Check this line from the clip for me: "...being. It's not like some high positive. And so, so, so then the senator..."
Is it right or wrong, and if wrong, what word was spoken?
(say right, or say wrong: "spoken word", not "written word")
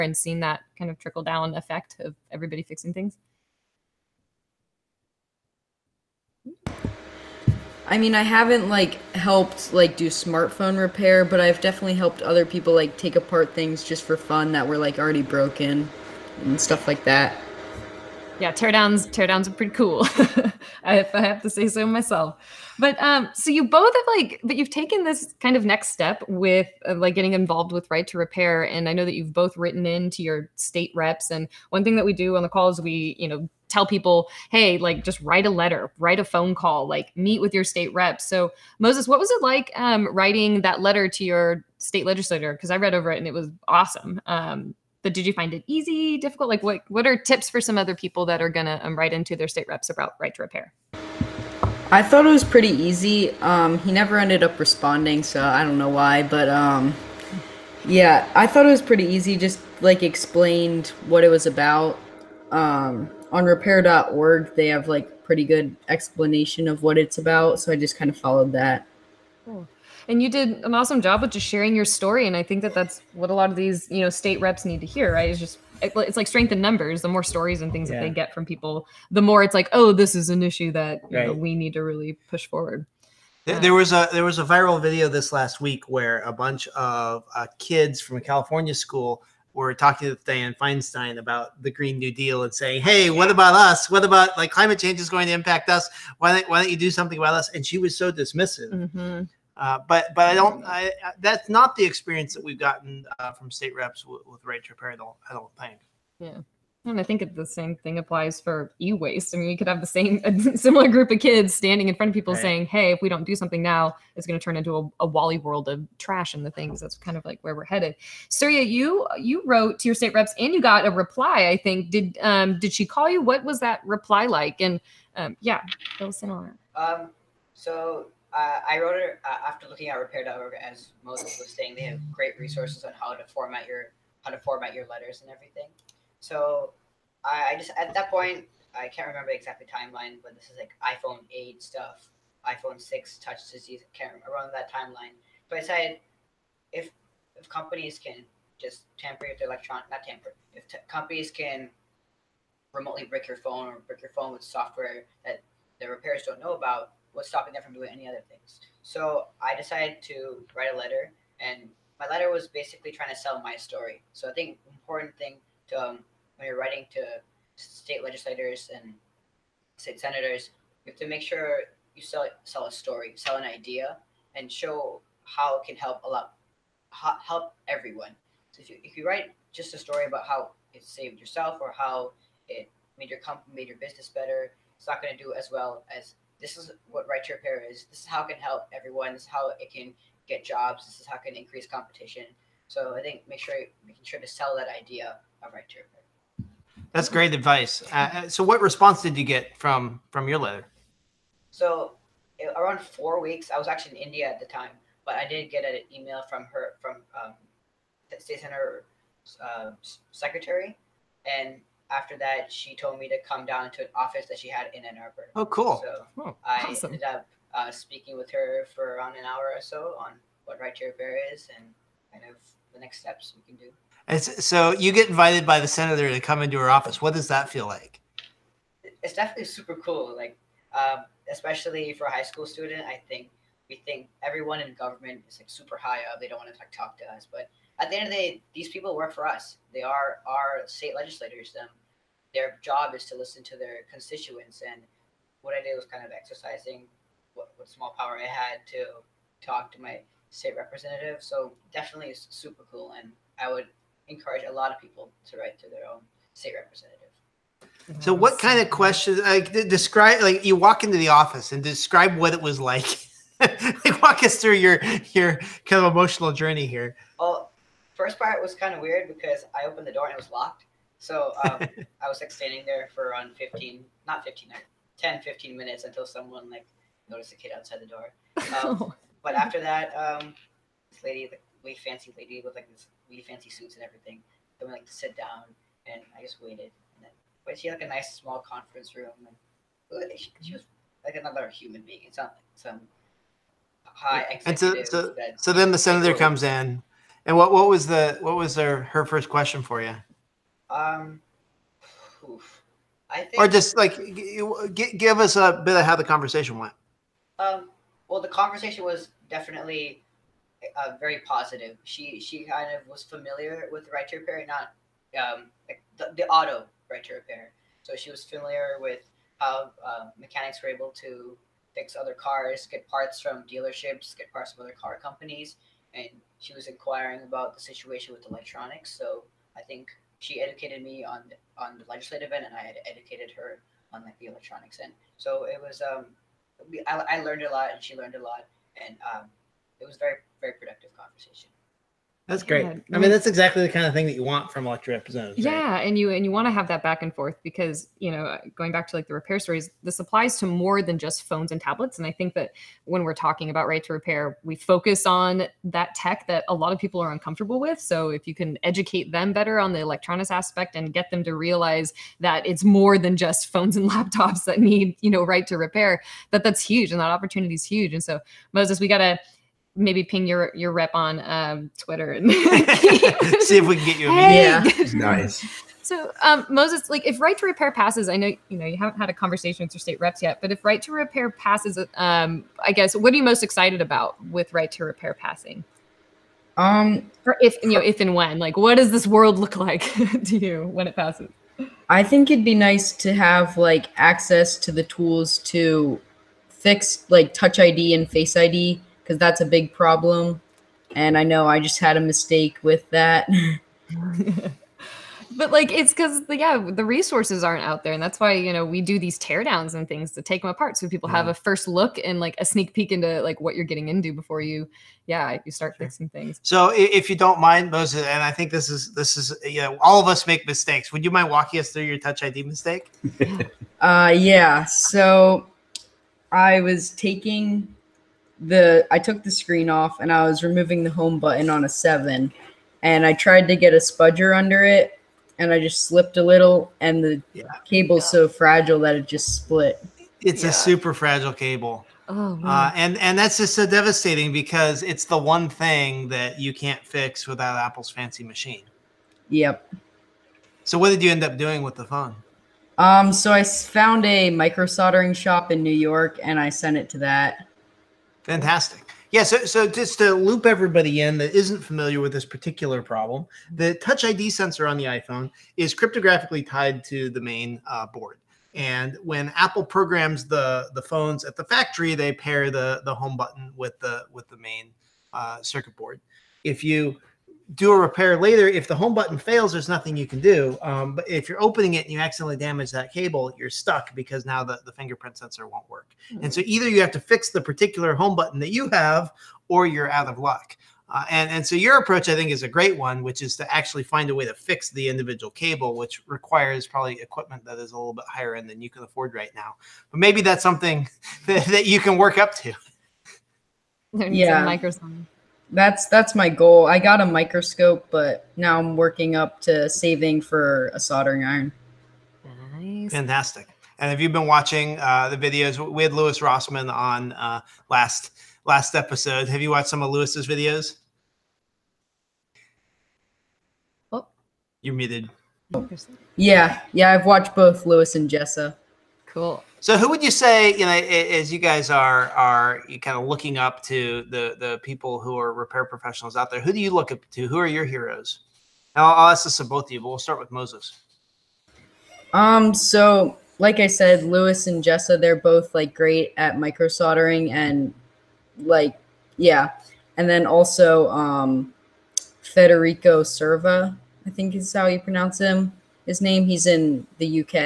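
wrong: "executive", not "positive".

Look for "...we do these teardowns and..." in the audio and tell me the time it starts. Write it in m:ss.
6:48.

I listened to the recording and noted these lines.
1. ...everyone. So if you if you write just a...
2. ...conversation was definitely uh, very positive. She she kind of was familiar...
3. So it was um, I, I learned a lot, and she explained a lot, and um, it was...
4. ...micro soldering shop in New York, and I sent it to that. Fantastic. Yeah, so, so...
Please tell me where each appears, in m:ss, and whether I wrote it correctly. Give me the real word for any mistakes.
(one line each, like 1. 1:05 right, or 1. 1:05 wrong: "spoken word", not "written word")
1. 2:57 right
2. 5:08 right
3. 5:35 wrong: "learned", not "explained"
4. 7:34 right.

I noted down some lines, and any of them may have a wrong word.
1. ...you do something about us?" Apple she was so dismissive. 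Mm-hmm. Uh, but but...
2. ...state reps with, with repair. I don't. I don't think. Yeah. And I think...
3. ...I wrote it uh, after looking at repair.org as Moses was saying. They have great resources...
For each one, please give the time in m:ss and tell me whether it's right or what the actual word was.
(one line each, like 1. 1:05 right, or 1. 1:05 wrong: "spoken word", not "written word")
1. 1:36 wrong: "And", not "Apple"
2. 1:43 right
3. 2:08 right.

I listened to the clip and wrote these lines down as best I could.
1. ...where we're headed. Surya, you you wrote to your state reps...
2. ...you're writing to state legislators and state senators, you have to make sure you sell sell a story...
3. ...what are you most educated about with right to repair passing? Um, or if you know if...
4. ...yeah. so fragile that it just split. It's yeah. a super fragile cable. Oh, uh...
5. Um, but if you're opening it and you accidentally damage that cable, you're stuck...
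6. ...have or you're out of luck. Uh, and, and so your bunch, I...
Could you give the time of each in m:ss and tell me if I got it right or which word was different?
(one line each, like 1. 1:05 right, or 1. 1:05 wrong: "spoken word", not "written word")
1. 1:57 right
2. 2:46 right
3. 6:22 wrong: "excited", not "educated"
4. 7:18 right
5. 8:00 right
6. 8:08 wrong: "approach", not "bunch".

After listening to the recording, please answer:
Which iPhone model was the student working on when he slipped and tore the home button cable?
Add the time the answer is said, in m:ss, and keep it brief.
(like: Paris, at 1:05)
iPhone 7, at 7:11.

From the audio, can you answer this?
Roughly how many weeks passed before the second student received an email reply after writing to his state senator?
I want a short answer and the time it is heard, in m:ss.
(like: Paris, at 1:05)
4, at 3:22.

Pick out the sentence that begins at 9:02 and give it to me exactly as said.
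Um, so like I said, Louis and Jessa, they're both like great at micro soldering and like yeah.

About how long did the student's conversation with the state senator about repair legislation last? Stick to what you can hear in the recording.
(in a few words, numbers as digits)
1 hour.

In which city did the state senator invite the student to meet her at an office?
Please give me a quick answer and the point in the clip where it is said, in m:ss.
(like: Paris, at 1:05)
Ann Arbor, at 3:34.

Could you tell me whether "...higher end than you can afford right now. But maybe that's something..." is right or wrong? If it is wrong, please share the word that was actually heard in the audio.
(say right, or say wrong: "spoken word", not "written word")
right.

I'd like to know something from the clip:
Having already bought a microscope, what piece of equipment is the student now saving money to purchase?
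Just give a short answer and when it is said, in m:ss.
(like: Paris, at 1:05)
Soldering iron, at 8:30.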